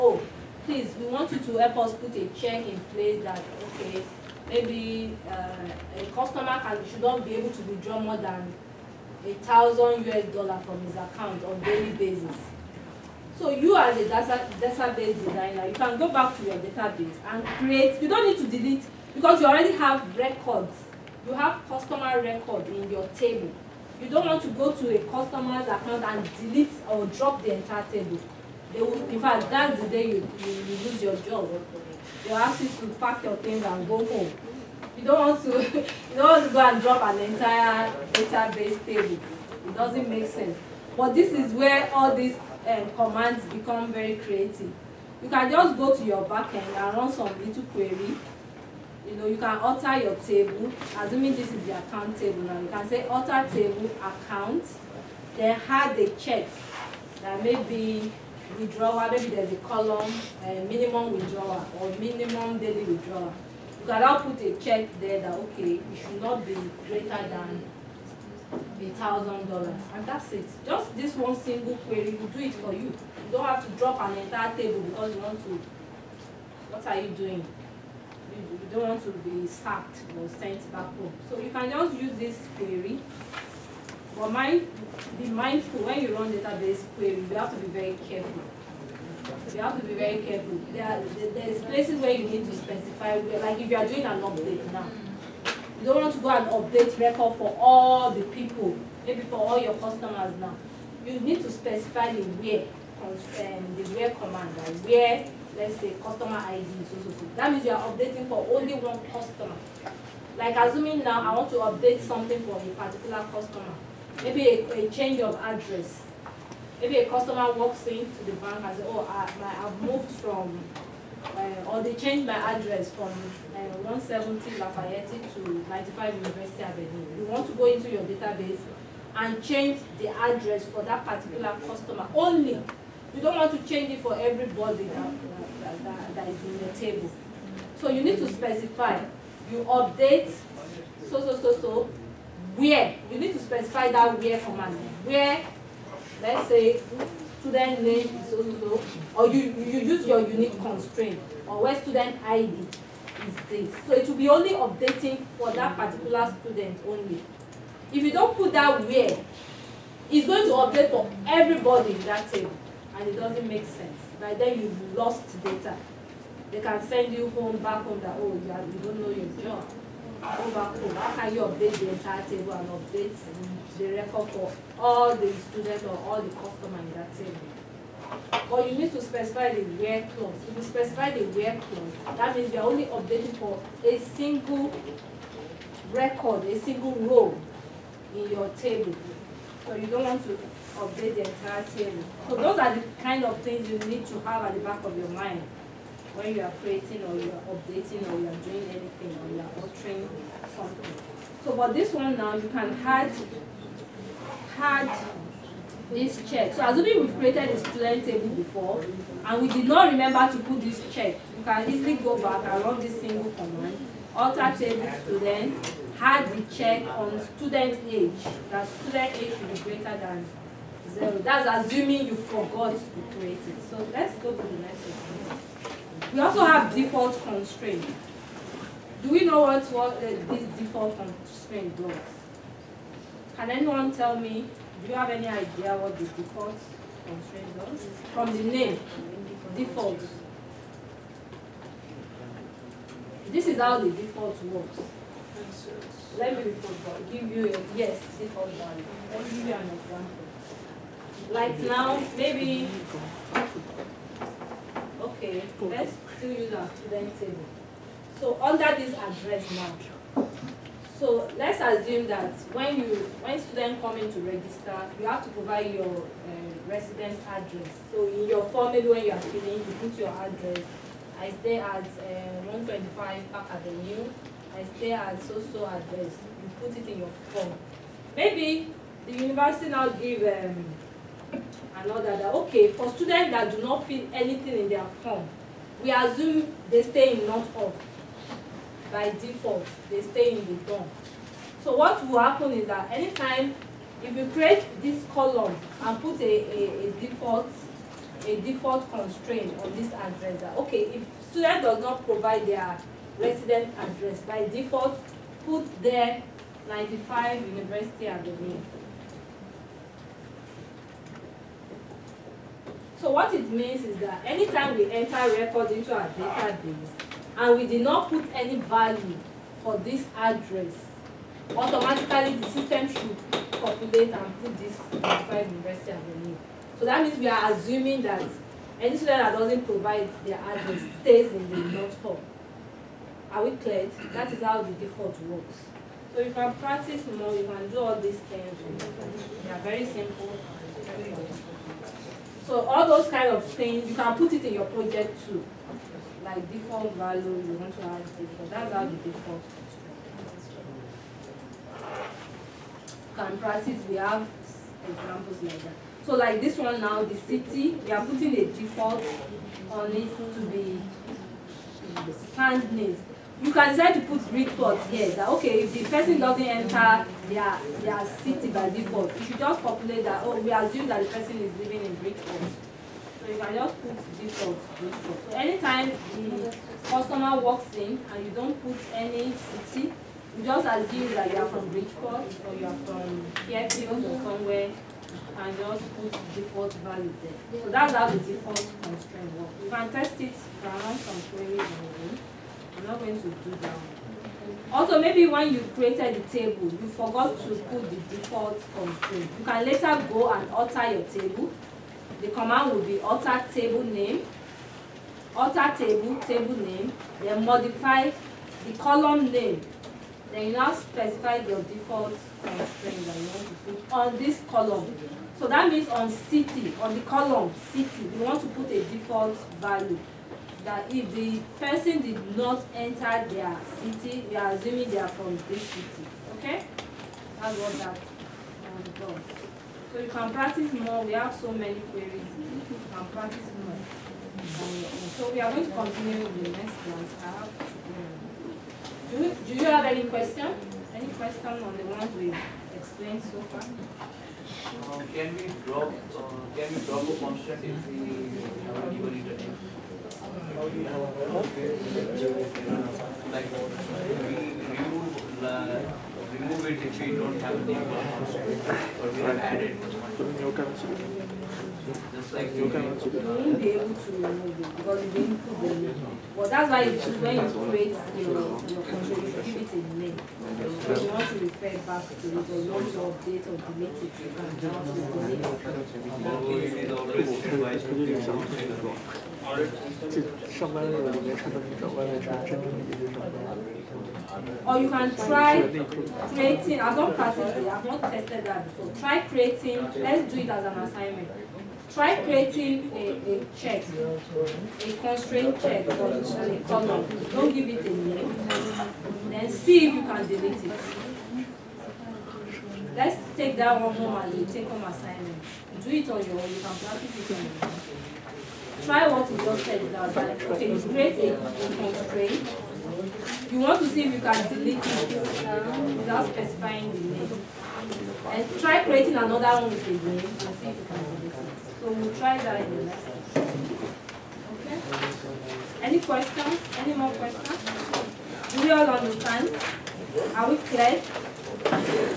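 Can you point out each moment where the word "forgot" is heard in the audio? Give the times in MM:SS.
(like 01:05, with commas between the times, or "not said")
03:42, 06:36.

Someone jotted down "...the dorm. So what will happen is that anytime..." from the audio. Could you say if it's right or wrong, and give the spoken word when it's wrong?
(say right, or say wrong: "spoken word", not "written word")
right.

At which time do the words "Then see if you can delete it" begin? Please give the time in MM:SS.
08:19.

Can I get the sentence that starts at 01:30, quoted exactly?
There there's places where you need to specify, like if you are doing an update now.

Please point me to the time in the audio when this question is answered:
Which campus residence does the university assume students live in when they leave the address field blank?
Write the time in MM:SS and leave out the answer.
05:31.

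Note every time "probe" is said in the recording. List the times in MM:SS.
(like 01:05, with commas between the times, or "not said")
not said.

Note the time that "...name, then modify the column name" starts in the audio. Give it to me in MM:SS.
06:46.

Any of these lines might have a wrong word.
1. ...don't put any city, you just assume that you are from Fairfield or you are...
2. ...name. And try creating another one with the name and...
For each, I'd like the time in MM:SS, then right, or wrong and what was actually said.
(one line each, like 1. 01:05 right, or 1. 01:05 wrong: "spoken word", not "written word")
1. 06:18 wrong: "Bridgeport", not "Fairfield"
2. 08:36 right.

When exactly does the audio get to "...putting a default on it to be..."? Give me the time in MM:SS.
05:58.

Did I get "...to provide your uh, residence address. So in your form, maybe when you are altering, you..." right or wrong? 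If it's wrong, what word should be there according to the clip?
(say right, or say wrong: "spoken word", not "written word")
wrong: "filling", not "altering".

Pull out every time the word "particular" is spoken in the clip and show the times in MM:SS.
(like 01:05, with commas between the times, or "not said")
01:52, 02:11, 02:35.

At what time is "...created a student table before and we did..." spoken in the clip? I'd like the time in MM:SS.
03:27.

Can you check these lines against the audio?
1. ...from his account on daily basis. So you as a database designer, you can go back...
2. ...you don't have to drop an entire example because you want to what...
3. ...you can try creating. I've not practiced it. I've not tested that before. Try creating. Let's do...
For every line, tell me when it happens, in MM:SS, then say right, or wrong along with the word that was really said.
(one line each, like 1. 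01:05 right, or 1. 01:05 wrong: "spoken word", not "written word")
1. 00:10 right
2. 01:12 wrong: "table", not "example"
3. 08:04 right.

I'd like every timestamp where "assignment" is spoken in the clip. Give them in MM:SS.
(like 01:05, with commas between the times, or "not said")
08:10, 08:24.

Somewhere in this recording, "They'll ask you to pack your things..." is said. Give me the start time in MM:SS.
00:32.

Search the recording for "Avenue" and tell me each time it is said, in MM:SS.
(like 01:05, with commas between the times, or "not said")
02:06, 04:33.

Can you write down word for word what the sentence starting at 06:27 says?
So that's how the default constraint works.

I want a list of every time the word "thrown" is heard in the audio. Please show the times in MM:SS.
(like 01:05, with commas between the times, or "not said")
not said.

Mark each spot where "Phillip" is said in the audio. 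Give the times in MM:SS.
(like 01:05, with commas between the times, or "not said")
not said.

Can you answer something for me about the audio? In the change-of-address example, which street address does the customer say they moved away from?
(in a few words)
170 Lafayette.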